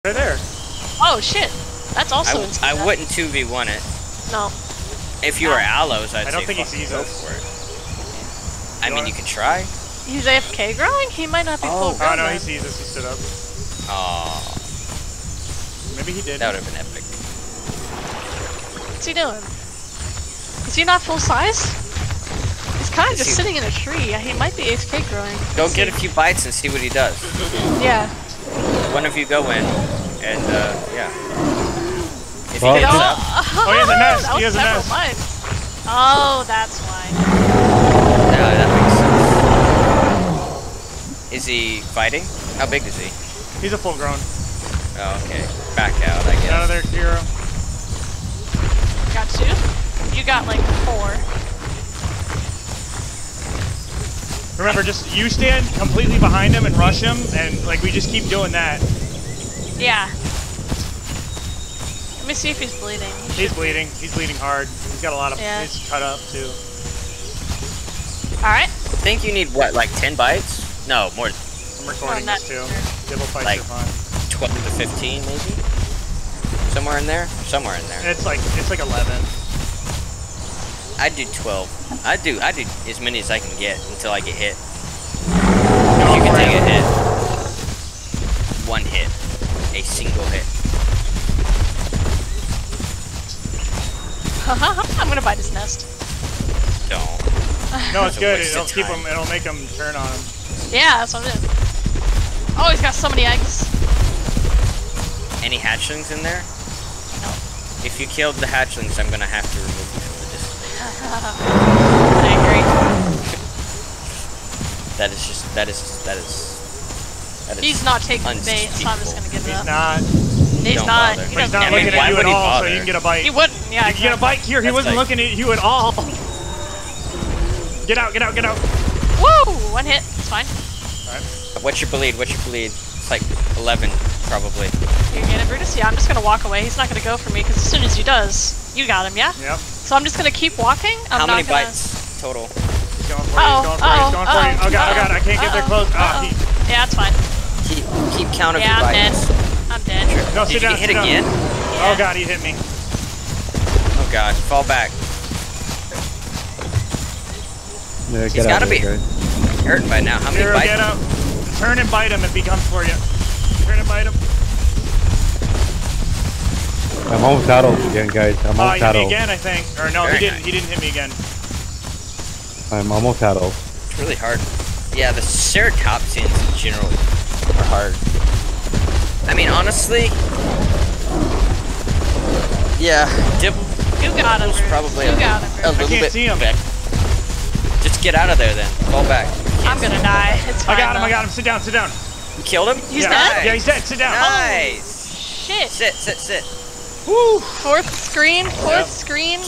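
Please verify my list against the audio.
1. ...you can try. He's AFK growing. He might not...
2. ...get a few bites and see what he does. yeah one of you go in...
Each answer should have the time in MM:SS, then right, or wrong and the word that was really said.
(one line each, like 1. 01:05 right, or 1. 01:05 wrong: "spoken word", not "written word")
1. 00:09 right
2. 00:25 right.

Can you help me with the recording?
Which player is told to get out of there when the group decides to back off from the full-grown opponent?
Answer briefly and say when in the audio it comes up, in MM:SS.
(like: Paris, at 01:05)
Kira, at 00:46.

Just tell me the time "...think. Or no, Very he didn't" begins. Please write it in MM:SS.
02:49.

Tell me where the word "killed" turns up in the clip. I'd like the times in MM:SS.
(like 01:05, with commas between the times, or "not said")
01:48, 03:12.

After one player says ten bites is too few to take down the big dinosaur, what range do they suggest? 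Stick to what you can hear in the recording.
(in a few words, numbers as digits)
12 to 15.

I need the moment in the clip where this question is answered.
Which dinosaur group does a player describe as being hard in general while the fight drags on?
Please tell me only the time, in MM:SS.
02:55.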